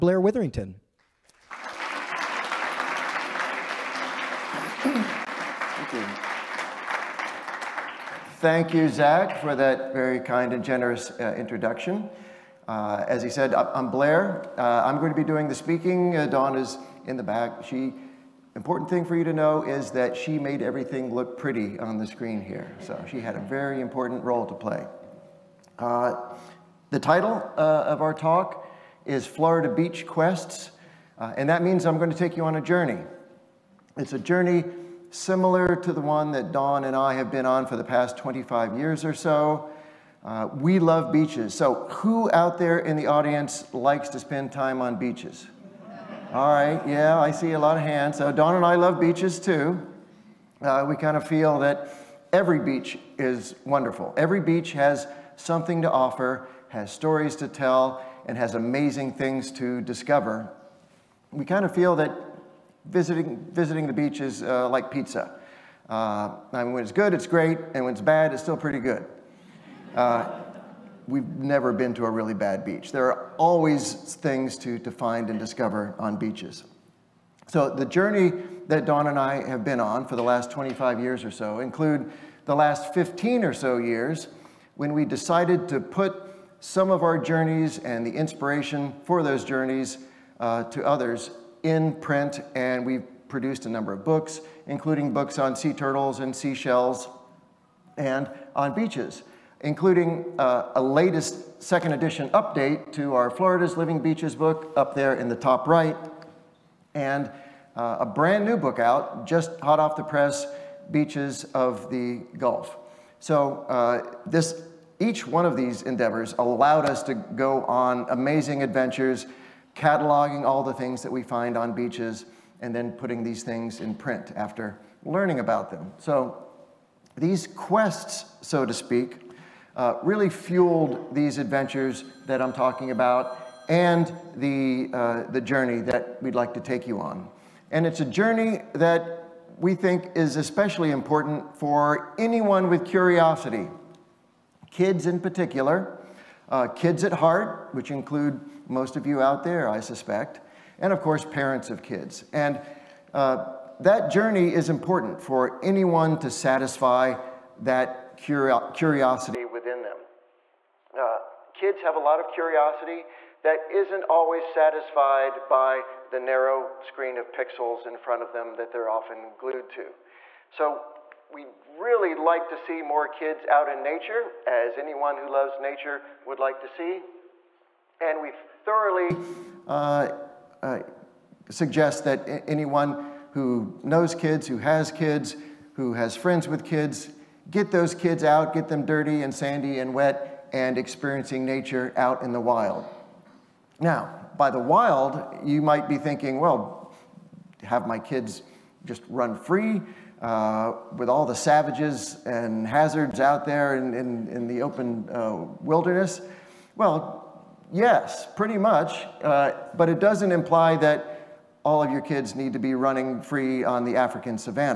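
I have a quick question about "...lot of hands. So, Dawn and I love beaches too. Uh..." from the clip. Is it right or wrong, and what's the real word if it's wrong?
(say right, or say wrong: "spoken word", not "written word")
right.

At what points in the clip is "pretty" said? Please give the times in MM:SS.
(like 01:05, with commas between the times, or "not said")
00:21, 01:08, 03:28.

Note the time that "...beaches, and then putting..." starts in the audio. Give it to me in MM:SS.
02:01.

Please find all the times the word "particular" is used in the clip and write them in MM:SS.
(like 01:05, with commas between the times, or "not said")
02:25.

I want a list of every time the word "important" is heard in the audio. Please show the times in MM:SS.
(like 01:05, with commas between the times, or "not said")
00:18, 00:23, 02:20, 02:34.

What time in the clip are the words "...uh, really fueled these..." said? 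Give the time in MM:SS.
02:09.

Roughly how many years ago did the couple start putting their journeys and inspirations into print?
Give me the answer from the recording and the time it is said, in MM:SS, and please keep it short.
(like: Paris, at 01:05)
15, at 01:22.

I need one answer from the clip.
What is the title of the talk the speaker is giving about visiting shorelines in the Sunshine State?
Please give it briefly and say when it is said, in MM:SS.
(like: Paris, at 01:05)
Florida Beach Quests, at 00:29.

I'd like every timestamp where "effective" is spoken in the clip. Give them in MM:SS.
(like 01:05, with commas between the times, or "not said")
not said.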